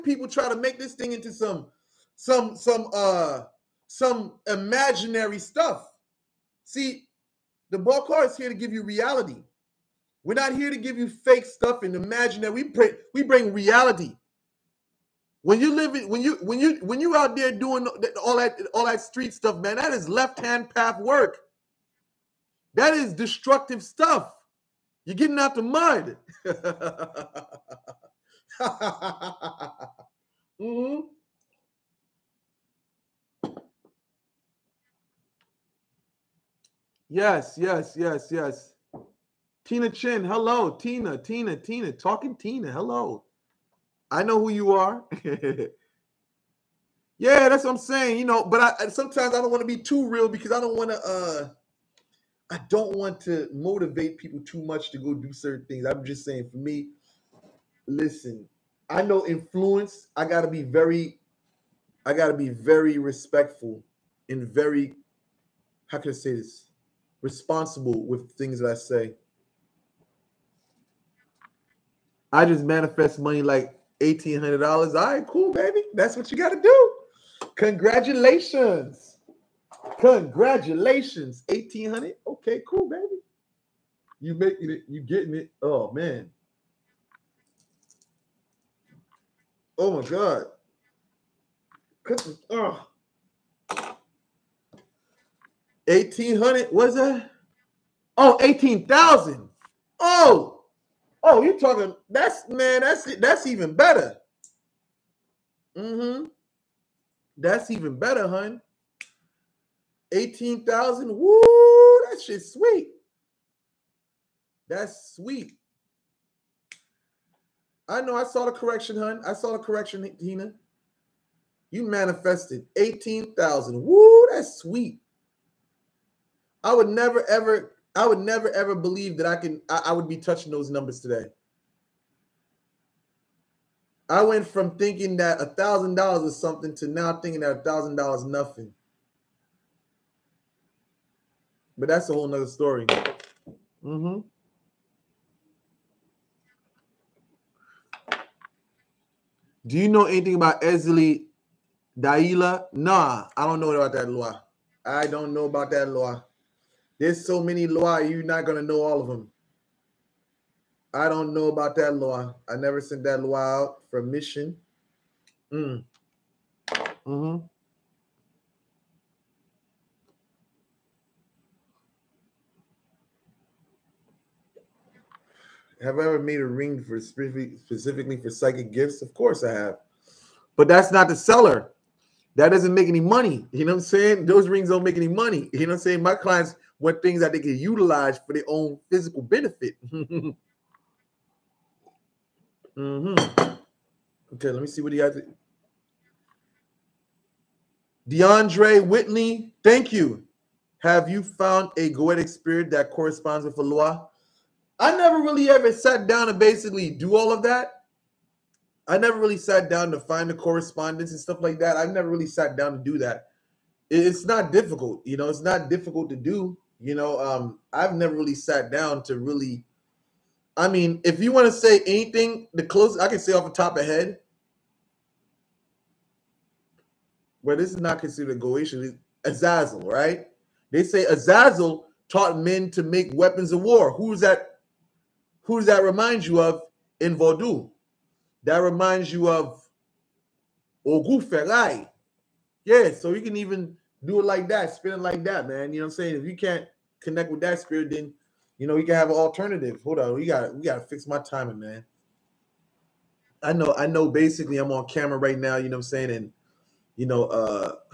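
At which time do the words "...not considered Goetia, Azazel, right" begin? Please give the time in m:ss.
3:47.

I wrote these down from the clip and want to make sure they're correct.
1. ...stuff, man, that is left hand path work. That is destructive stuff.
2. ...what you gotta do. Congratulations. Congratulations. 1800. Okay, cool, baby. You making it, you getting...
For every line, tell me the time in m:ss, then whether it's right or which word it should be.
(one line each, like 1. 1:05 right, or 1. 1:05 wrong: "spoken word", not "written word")
1. 0:19 right
2. 1:16 right.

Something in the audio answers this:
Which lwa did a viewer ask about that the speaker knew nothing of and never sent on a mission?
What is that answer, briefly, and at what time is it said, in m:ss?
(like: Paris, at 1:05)
Ezli Daila, at 2:30.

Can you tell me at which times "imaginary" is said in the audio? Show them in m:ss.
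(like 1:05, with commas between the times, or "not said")
0:04, 0:11.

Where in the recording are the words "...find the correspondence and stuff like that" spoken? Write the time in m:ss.
3:30.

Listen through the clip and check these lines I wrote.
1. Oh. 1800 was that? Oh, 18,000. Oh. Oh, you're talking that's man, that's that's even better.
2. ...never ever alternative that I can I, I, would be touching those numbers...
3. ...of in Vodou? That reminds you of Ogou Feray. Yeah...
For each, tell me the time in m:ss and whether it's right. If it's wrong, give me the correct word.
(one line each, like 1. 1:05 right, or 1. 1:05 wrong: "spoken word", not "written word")
1. 1:32 right
2. 2:08 wrong: "believe", not "alternative"
3. 3:56 right.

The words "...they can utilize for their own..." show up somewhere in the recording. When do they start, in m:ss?
3:07.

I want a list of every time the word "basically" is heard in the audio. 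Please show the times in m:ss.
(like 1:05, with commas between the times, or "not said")
3:26, 4:14.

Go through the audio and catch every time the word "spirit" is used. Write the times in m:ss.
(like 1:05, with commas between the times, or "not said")
3:22, 4:07.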